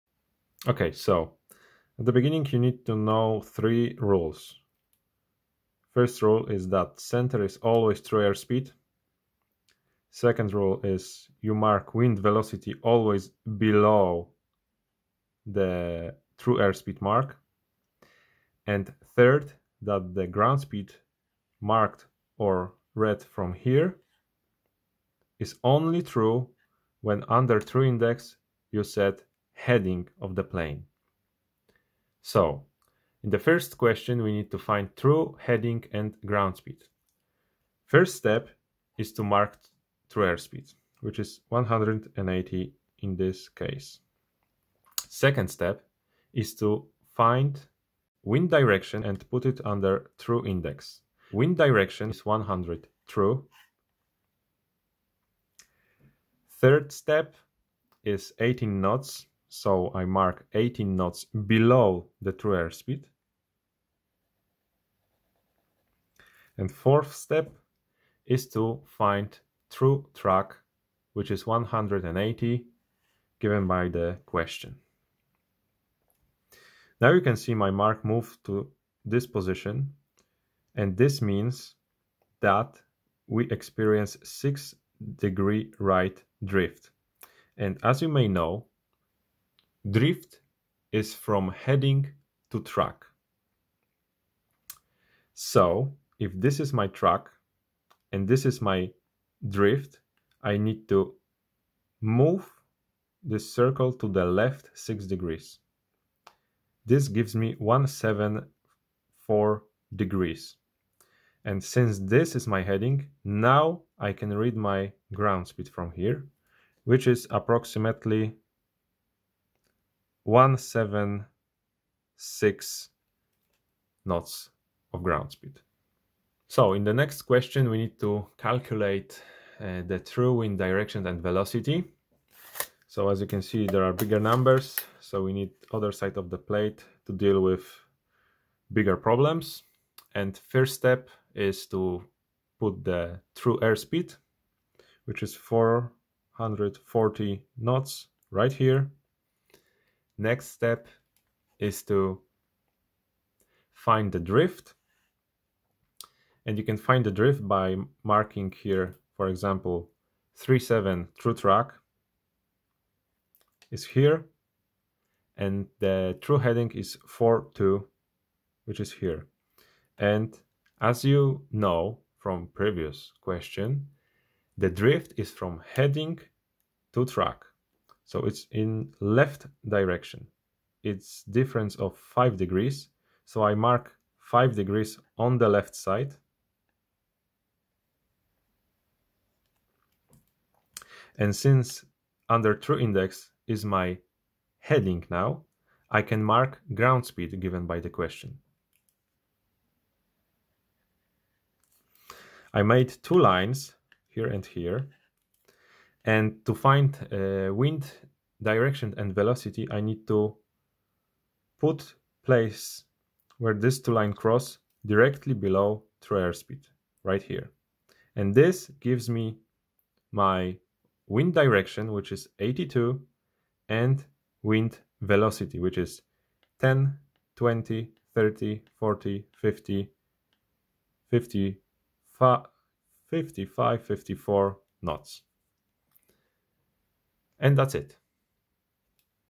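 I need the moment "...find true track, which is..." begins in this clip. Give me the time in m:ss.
1:08.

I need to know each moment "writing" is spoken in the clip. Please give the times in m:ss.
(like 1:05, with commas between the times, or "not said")
not said.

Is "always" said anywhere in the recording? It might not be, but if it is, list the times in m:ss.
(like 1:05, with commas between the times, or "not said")
0:07, 0:12.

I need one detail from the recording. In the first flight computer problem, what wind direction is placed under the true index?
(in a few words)
100 true.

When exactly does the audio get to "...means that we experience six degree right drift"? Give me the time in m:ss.
1:21.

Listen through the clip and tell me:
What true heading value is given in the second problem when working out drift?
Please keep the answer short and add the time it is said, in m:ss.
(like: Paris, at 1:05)
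42, at 2:47.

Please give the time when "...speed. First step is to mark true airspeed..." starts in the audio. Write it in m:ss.
0:36.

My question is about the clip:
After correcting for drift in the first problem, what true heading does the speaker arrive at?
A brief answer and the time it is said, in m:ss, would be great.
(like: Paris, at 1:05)
174 degrees, at 1:47.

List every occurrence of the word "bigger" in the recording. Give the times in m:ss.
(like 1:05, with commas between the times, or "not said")
2:13, 2:18.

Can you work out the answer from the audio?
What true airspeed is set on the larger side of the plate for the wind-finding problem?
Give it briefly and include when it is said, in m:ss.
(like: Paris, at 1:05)
440 knots, at 2:25.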